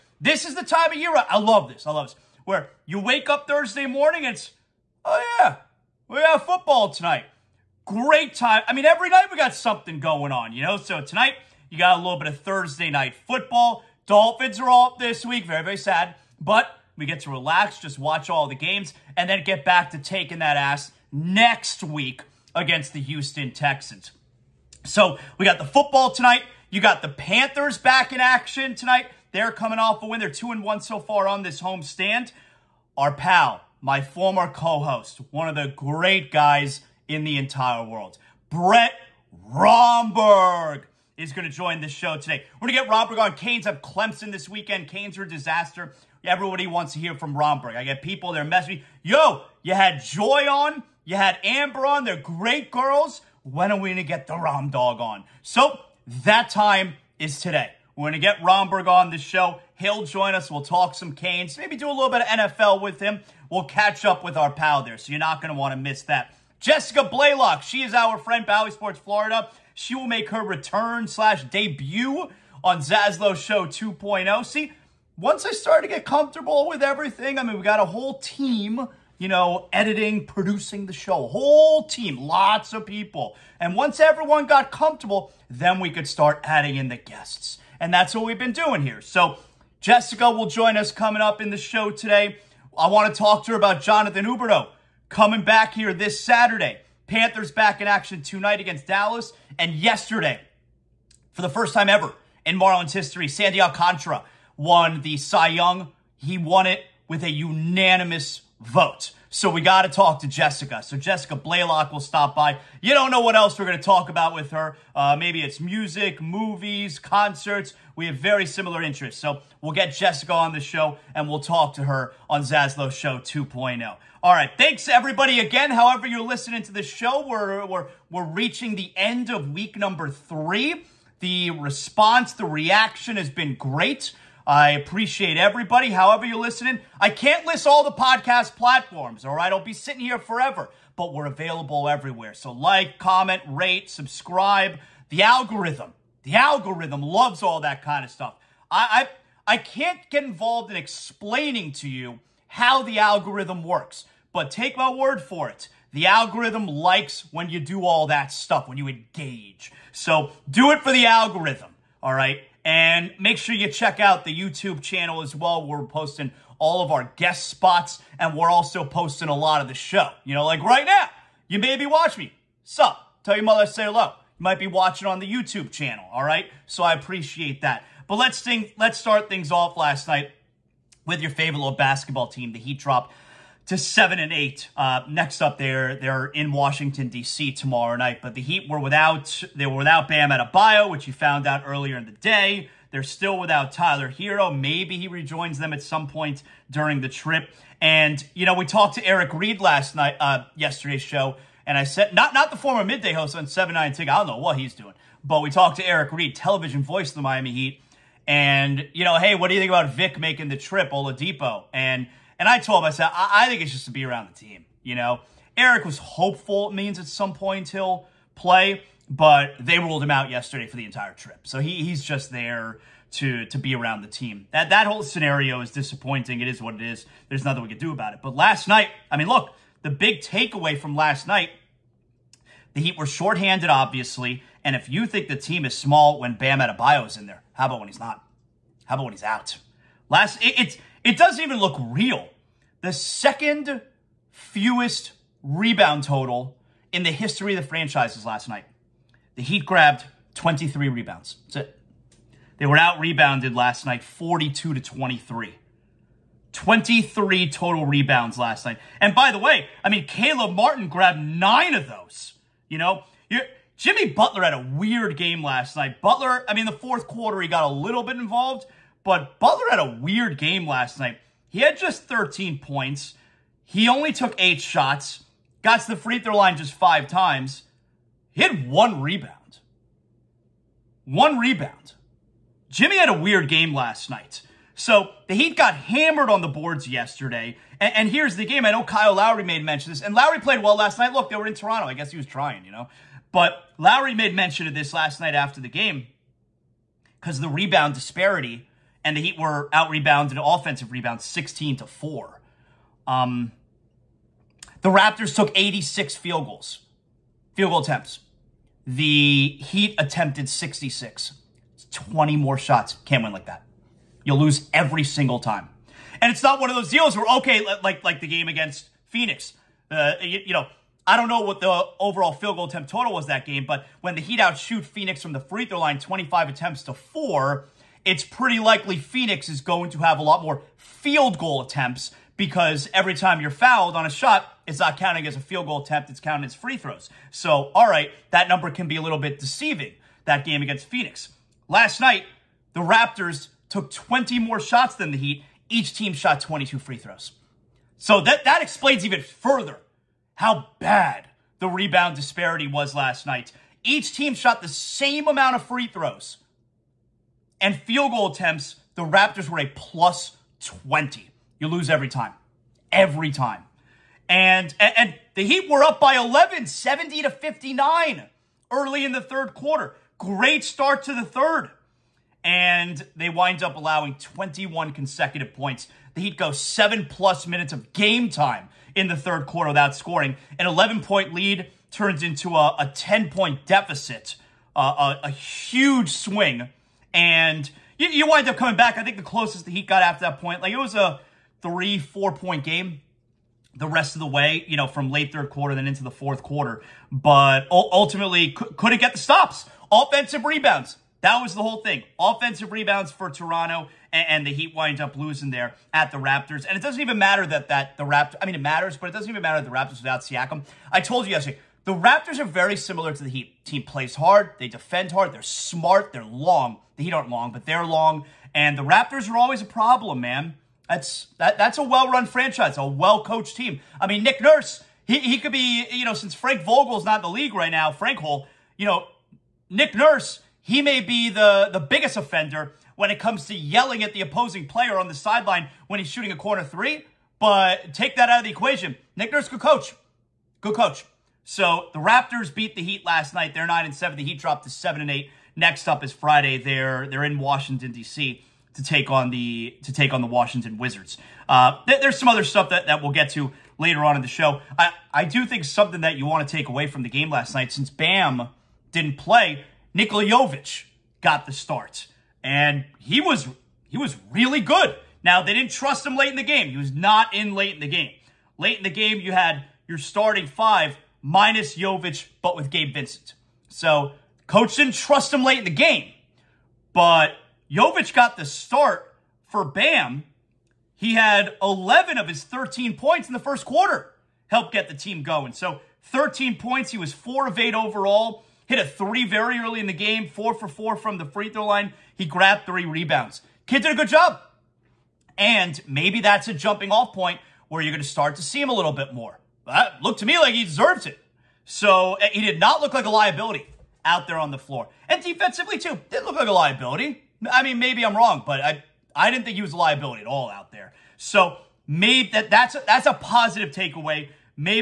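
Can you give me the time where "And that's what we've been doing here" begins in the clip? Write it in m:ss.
1:27.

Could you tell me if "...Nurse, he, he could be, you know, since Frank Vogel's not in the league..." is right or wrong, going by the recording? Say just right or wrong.
right.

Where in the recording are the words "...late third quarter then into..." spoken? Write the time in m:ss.
6:35.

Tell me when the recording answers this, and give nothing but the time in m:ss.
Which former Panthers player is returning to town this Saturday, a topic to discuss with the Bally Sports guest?
1:33.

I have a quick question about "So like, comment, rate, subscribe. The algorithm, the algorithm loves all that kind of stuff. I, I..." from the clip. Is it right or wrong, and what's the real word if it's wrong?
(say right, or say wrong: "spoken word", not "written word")
right.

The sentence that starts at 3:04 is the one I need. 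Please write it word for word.
Uh, next up, they're they're in Washington D.C.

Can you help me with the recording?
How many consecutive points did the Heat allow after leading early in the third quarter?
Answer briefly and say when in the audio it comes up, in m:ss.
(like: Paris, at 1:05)
21, at 6:14.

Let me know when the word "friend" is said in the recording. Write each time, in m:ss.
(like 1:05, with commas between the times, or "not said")
1:08.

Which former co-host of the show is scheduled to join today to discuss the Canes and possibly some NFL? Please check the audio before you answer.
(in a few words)
Brett Romberg.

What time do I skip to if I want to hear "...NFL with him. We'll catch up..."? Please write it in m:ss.
1:02.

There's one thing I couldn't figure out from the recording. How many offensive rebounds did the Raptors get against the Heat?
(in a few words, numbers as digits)
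16.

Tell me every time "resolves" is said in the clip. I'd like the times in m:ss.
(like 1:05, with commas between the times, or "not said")
not said.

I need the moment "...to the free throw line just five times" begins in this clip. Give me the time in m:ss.
4:35.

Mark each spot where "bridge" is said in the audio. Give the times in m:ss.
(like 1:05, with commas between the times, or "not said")
not said.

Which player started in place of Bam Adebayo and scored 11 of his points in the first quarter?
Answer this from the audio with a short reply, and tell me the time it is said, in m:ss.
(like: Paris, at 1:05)
Nikola Jovic, at 7:39.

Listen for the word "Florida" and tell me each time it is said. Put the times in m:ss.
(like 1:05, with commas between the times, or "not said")
1:08.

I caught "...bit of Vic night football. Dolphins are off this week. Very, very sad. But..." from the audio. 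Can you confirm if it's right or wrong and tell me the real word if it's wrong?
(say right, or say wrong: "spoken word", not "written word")
wrong: "Thursday", not "Vic".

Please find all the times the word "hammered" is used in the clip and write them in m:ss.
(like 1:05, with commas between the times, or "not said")
4:45.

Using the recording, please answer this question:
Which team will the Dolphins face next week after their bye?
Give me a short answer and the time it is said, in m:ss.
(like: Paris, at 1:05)
Houston Texans, at 0:23.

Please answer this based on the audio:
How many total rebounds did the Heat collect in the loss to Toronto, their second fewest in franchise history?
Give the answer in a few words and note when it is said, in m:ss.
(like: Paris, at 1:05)
23, at 4:10.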